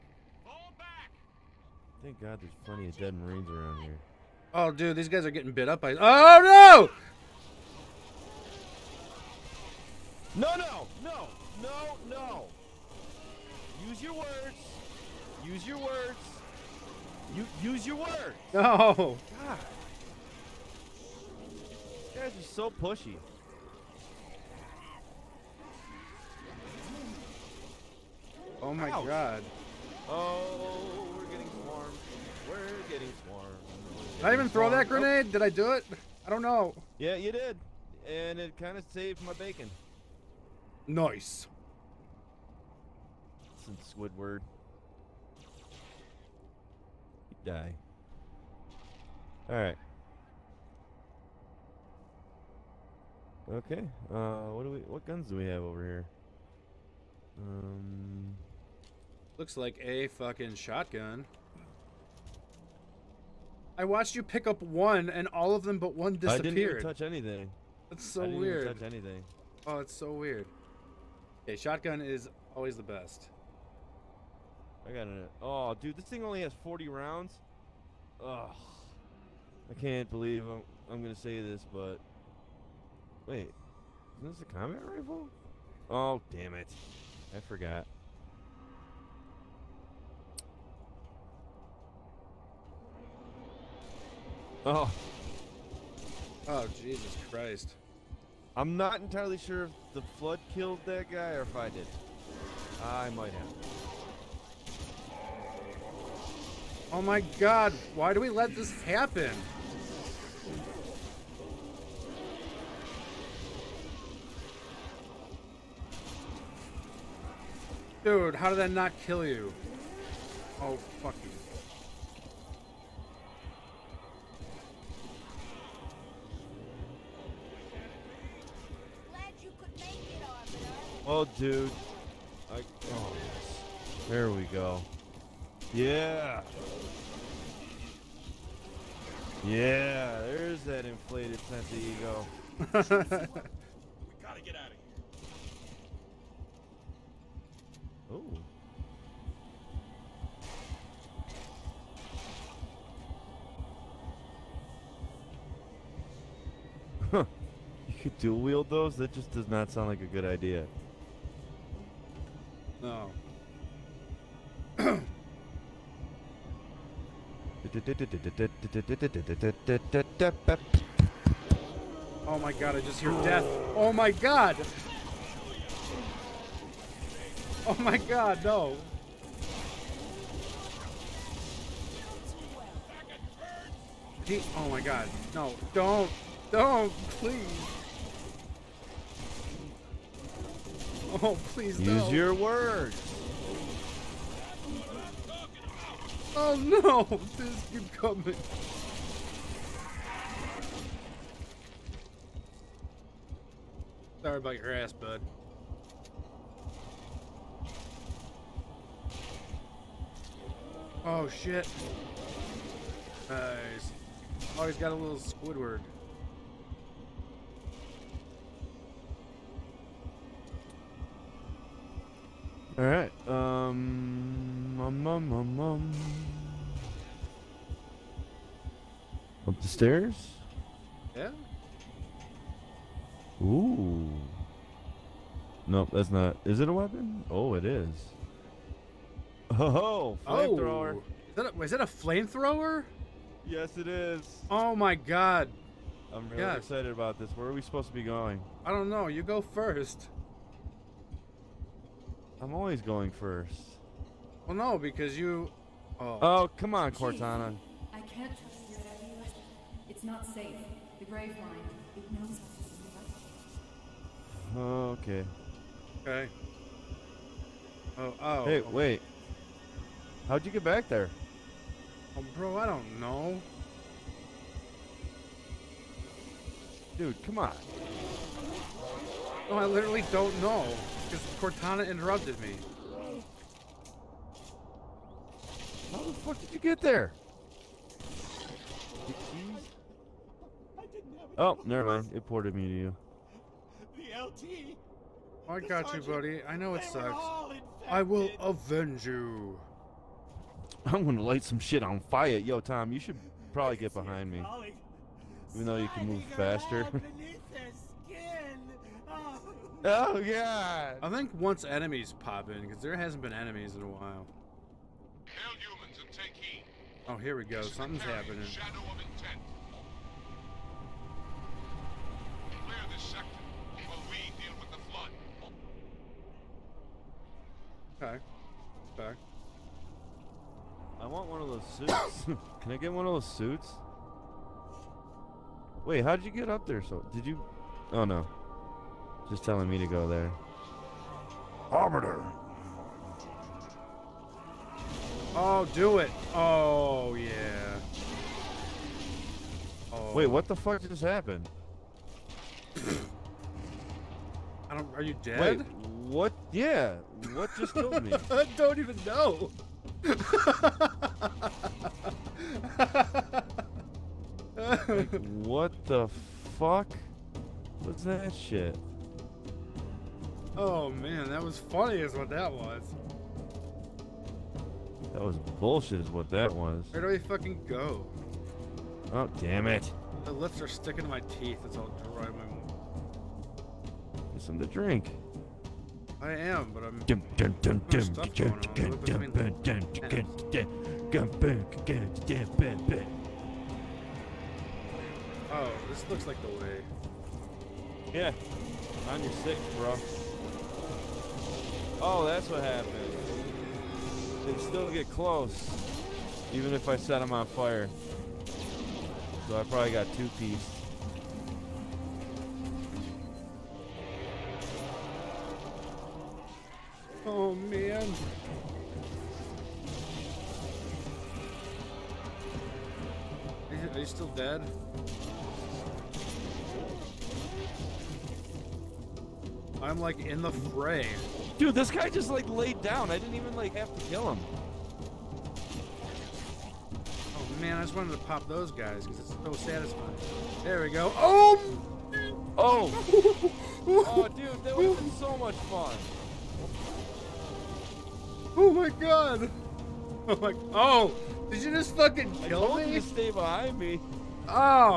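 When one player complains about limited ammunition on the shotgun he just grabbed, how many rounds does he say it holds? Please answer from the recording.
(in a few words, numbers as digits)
40.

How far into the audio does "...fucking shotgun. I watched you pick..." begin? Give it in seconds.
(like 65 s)
60 s.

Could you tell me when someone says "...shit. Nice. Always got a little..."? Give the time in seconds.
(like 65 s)
211 s.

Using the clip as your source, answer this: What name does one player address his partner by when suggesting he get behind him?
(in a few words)
Tom.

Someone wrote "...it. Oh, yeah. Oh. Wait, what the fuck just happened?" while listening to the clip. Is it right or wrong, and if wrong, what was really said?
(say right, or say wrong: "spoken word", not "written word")
right.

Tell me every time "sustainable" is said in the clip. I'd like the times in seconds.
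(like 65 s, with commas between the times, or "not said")
not said.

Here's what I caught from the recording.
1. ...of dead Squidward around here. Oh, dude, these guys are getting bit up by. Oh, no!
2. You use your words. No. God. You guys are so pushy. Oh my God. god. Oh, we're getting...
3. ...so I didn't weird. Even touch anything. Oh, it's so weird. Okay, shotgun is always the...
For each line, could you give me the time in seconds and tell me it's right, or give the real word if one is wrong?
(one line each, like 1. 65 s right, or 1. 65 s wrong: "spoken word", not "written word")
1. 2 s wrong: "Marines", not "Squidward"
2. 17 s wrong: "Ouch", not "God"
3. 68 s right.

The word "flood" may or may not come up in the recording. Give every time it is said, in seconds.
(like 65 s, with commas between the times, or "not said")
100 s, 324 s.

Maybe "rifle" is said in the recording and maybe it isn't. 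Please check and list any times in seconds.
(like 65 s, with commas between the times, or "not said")
84 s.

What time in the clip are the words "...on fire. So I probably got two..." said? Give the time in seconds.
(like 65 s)
407 s.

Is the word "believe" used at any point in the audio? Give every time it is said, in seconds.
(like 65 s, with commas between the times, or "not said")
80 s.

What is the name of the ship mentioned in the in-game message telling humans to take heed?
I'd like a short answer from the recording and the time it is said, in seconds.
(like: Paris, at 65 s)
Shadow of Intent, at 318 s.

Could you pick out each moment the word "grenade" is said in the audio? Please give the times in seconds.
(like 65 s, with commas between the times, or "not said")
34 s.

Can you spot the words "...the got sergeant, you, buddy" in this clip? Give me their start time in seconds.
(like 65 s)
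295 s.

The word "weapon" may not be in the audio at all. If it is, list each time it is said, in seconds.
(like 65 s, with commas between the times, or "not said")
236 s.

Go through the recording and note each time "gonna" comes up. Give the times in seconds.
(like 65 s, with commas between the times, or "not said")
81 s, 301 s.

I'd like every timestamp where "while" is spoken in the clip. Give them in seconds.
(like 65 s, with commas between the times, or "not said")
313 s, 323 s.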